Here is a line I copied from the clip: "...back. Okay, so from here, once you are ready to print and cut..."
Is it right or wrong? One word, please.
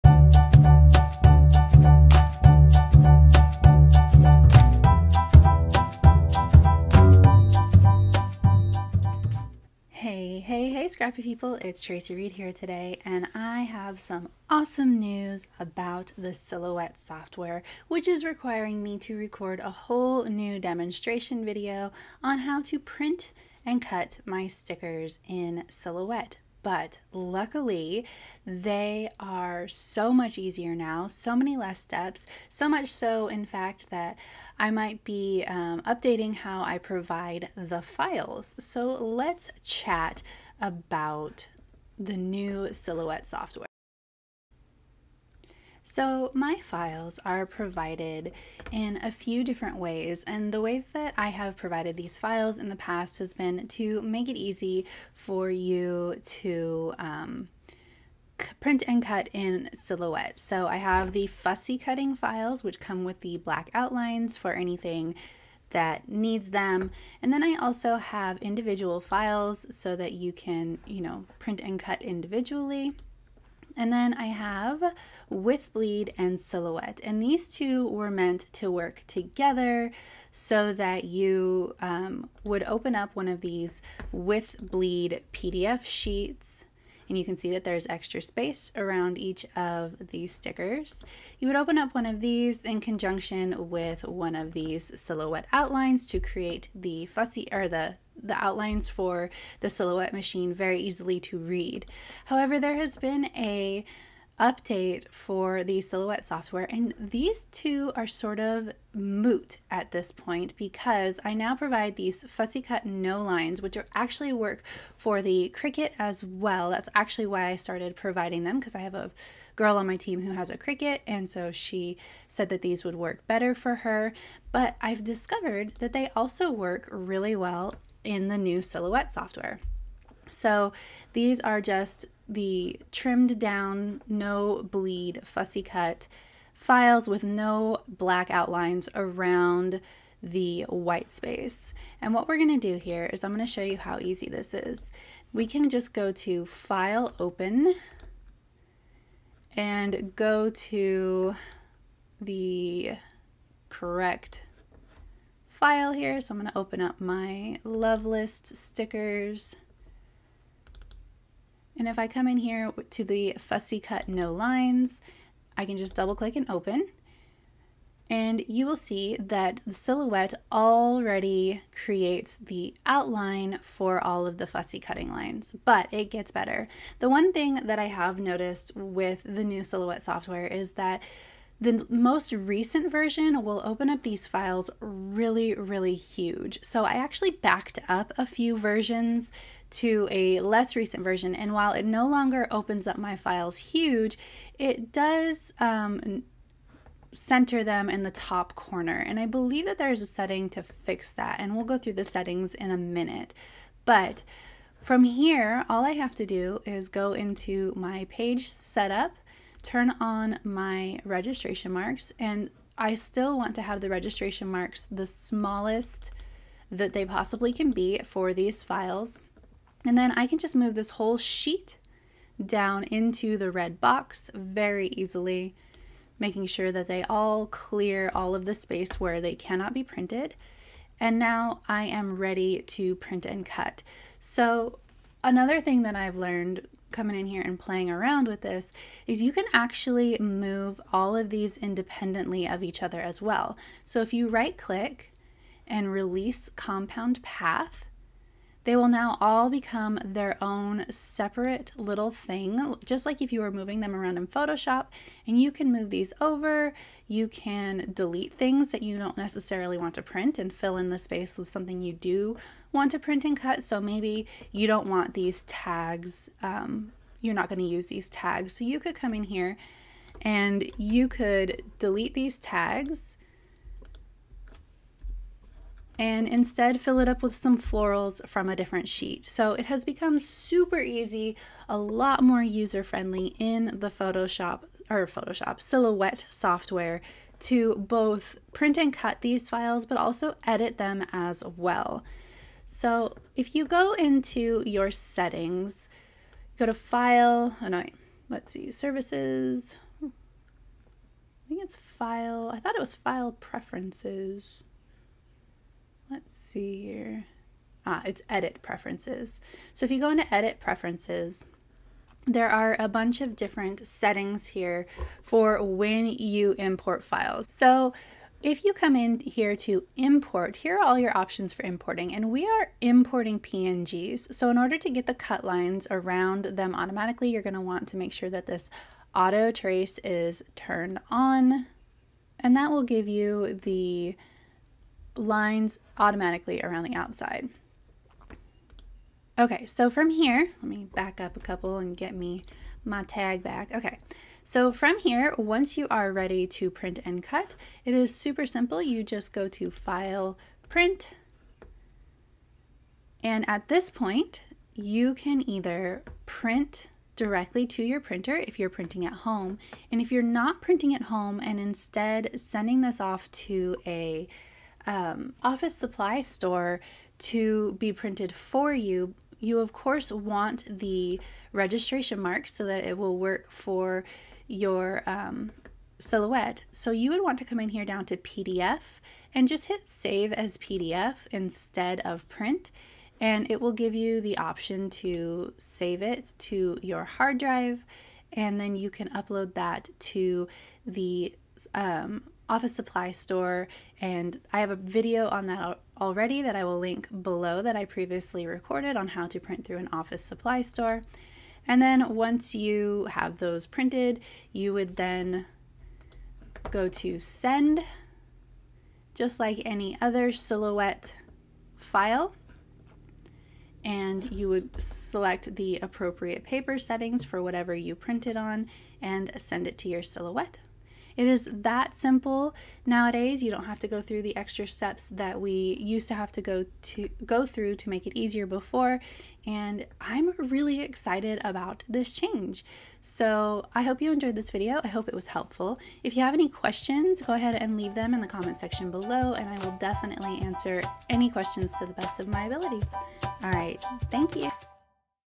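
right.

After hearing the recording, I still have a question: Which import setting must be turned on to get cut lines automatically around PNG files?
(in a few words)
auto trace.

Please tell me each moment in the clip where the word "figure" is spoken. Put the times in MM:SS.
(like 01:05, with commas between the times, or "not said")
not said.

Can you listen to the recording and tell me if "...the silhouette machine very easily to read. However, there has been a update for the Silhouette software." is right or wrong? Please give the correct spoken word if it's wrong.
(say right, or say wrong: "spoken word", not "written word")
right.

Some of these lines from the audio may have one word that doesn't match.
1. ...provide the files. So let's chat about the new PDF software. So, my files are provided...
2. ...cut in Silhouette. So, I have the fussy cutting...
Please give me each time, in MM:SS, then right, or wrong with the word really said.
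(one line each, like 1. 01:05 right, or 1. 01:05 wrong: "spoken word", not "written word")
1. 00:36 wrong: "Silhouette", not "PDF"
2. 00:59 right.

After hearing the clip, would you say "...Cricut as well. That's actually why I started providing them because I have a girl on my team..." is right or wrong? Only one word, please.
right.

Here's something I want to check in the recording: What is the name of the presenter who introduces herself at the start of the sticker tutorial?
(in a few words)
Traci Reed.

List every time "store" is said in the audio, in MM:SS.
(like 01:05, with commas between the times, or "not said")
06:06, 06:33, 06:40.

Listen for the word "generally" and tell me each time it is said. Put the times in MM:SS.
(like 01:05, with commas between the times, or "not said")
not said.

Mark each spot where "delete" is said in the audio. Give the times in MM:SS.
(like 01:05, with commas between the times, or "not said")
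04:17, 04:31.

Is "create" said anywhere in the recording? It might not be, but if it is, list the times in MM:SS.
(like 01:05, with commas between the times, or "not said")
01:36, 02:51.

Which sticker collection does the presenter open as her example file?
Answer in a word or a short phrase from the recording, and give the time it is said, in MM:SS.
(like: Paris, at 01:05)
love list, at 02:37.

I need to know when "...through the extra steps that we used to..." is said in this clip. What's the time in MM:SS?
07:04.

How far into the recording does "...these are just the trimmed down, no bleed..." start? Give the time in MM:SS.
02:11.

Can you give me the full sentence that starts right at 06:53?
And you would select the appropriate paper settings for whatever you printed on and send it to your silhouette.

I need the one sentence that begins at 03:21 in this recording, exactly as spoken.
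And we'll go through the settings in a minute.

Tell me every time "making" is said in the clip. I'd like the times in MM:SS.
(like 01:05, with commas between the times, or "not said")
03:46.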